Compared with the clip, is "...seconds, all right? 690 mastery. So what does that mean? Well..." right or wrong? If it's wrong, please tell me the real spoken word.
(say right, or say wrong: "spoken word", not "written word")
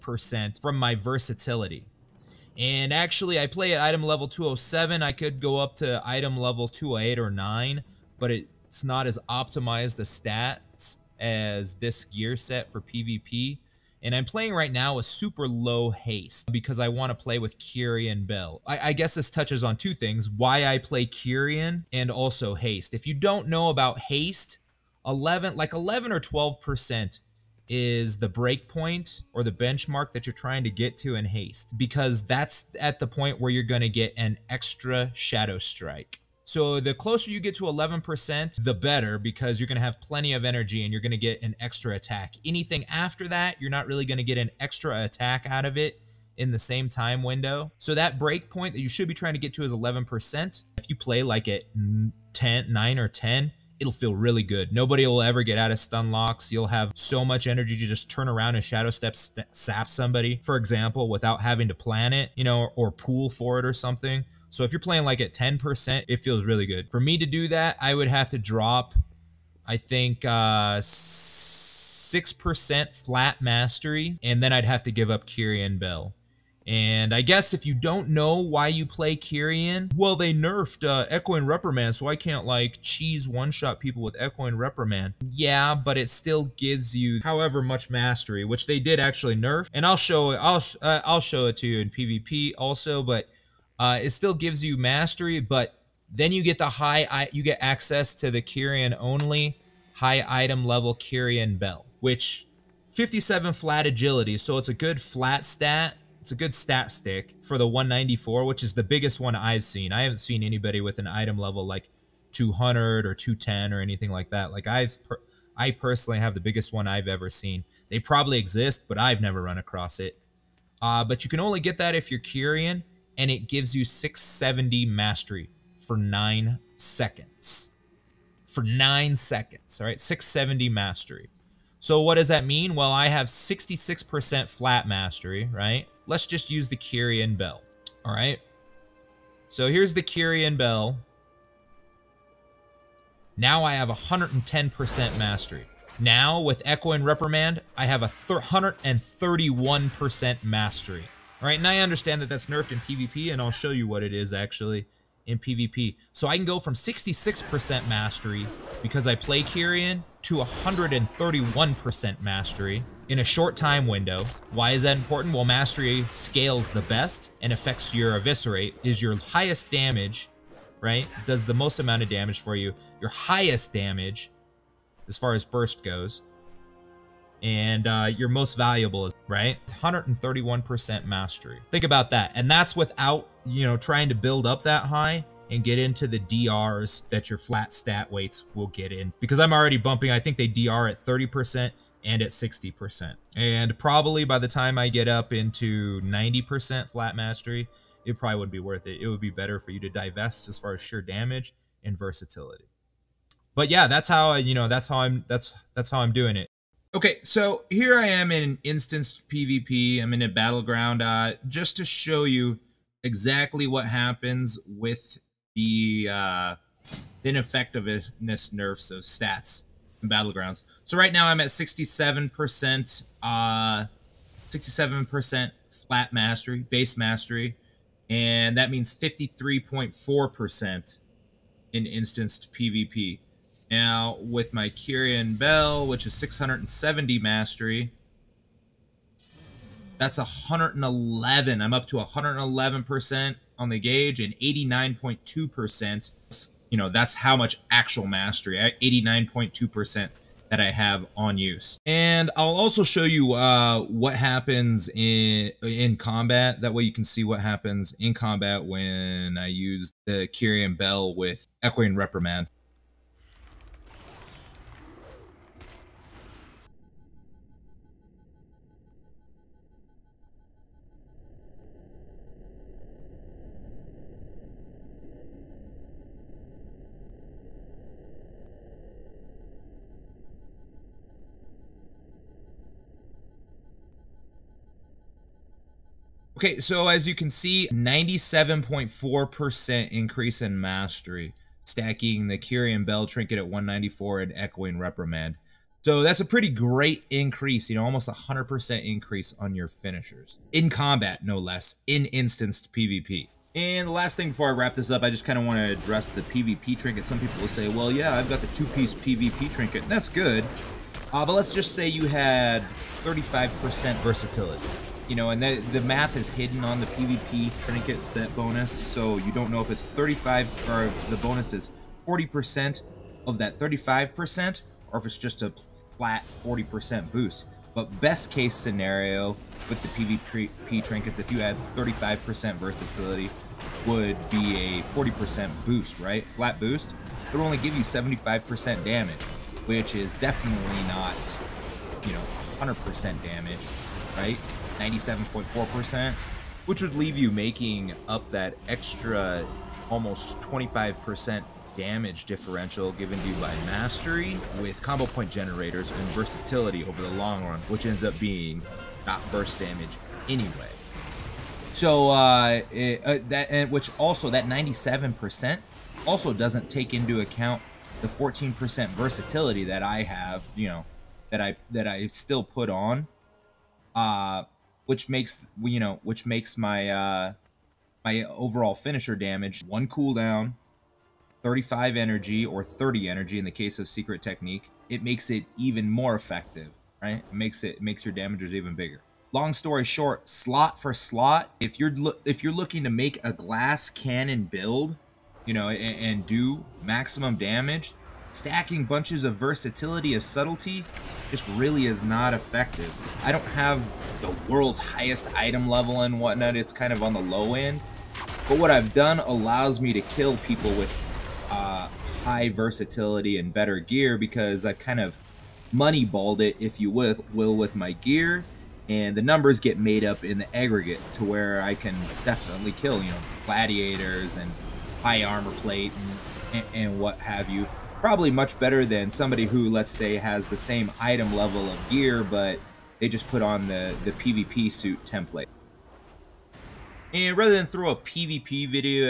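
wrong: "670", not "690".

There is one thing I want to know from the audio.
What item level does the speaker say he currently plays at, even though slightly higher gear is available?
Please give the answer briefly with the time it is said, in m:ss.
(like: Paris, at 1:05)
207, at 0:03.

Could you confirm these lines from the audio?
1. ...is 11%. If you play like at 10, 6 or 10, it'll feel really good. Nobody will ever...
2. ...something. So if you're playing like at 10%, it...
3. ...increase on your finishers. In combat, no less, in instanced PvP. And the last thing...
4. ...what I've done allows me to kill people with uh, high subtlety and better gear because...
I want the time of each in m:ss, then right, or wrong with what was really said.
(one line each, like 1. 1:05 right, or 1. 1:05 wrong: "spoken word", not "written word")
1. 0:49 wrong: "9", not "6"
2. 1:03 right
3. 4:58 right
4. 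6:48 wrong: "versatility", not "subtlety".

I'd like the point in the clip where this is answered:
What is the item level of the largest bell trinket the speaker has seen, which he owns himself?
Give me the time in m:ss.
1:47.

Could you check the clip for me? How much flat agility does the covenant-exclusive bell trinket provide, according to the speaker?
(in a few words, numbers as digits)
57.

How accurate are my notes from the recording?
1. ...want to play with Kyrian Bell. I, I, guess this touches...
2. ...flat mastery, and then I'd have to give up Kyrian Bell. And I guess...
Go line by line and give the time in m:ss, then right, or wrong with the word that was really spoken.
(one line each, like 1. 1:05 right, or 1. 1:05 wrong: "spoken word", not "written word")
1. 0:16 right
2. 1:13 right.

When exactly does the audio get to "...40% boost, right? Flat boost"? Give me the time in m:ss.
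5:34.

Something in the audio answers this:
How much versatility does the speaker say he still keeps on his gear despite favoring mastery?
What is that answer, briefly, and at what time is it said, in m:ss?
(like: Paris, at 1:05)
14%, at 6:08.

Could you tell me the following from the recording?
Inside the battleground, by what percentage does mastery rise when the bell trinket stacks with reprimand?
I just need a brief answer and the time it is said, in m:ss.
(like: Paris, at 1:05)
97.4%, at 4:47.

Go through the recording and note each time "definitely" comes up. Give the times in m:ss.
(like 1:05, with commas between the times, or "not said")
5:40, 7:02.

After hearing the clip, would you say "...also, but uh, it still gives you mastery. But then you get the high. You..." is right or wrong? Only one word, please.
right.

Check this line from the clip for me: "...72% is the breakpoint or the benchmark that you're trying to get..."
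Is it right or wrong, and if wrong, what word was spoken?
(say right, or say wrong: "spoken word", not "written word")
wrong: "12", not "72".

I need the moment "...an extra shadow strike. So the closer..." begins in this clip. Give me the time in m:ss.
0:34.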